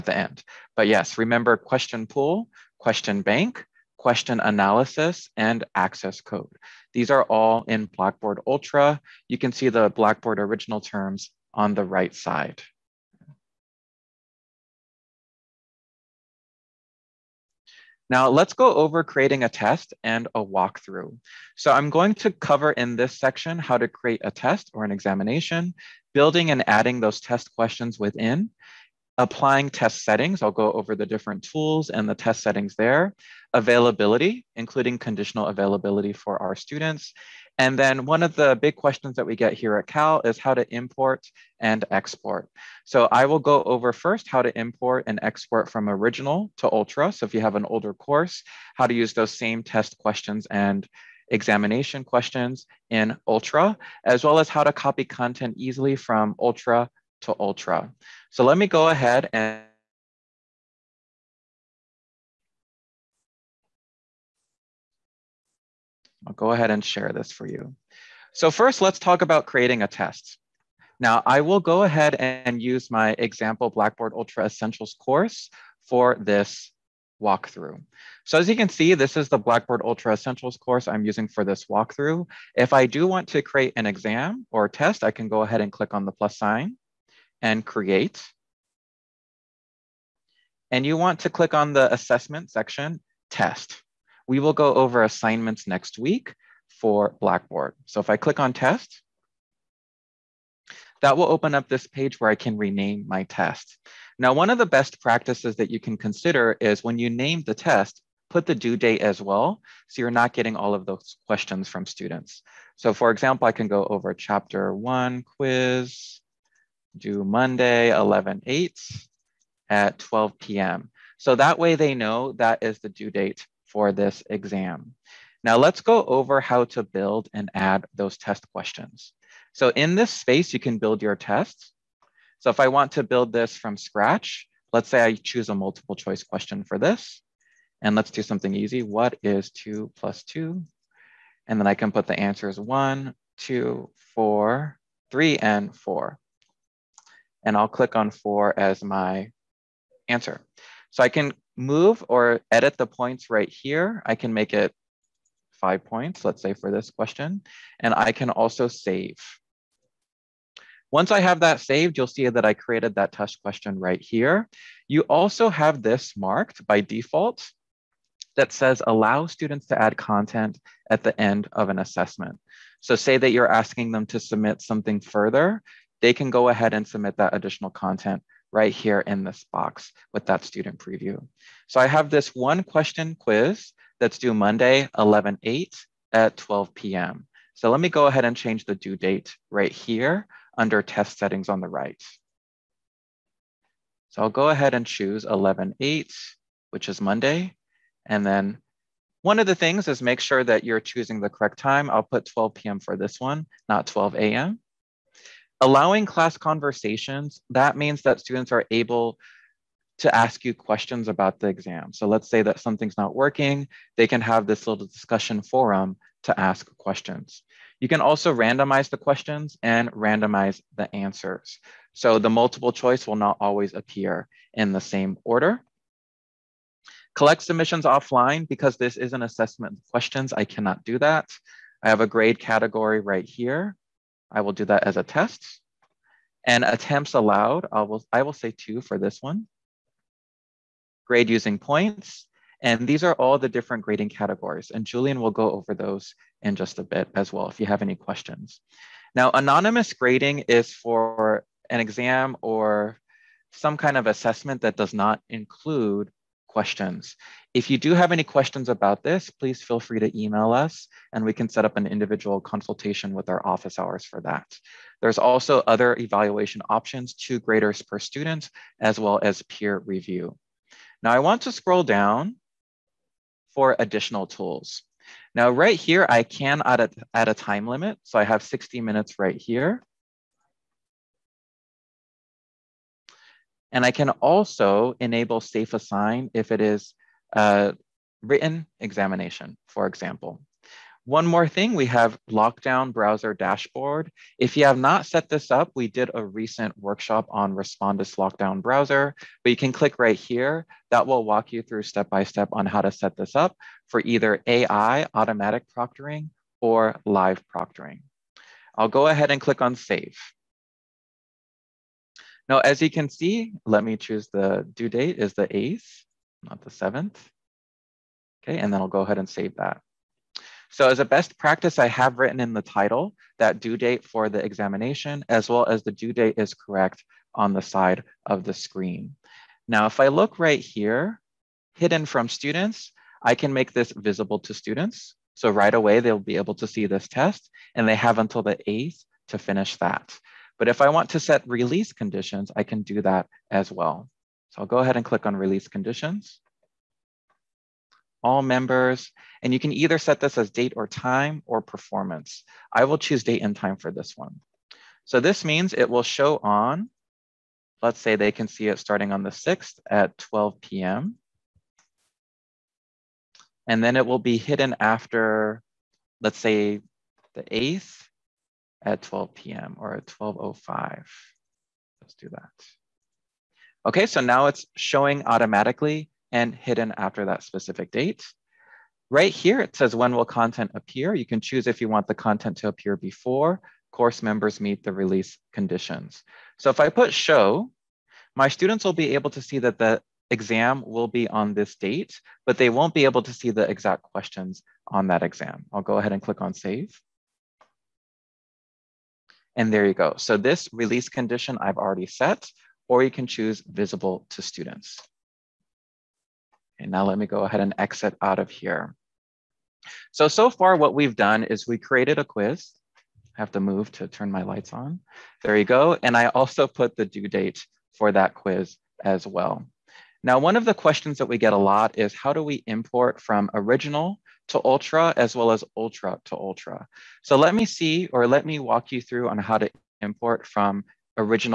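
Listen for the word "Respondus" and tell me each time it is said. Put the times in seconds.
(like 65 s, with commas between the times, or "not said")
297 s.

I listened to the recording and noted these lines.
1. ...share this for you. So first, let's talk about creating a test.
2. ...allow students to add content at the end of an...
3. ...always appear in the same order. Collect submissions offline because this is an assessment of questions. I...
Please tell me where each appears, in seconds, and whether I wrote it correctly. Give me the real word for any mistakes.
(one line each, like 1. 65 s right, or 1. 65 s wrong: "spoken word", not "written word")
1. 66 s right
2. 168 s right
3. 223 s right.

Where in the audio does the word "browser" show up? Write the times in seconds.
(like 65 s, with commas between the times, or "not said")
292 s, 298 s.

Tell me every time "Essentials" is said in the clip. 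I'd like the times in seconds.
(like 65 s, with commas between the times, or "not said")
74 s, 80 s.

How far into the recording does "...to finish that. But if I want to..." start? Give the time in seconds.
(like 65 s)
339 s.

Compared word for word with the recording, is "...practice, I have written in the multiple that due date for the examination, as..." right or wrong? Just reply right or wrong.
wrong.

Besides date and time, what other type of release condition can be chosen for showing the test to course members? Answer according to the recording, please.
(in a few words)
performance.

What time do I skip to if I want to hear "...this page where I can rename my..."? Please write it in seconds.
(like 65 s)
101 s.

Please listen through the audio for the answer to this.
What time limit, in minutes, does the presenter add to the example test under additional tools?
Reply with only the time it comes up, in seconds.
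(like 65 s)
278 s.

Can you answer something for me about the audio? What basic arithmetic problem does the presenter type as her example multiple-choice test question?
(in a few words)
What is two plus two?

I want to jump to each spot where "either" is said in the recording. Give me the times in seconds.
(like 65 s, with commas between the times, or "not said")
304 s, 349 s.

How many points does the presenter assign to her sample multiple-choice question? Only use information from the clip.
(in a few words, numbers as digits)
5.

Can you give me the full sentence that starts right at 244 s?
And Julian will go over those in just a bit as well if you have any questions.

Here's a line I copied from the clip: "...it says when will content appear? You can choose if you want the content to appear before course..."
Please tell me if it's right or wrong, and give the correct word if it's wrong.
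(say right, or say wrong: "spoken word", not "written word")
right.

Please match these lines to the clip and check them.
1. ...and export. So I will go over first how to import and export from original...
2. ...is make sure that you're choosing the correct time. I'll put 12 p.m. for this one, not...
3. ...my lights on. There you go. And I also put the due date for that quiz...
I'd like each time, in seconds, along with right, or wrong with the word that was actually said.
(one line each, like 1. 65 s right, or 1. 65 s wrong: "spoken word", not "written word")
1. 41 s right
2. 199 s right
3. 414 s right.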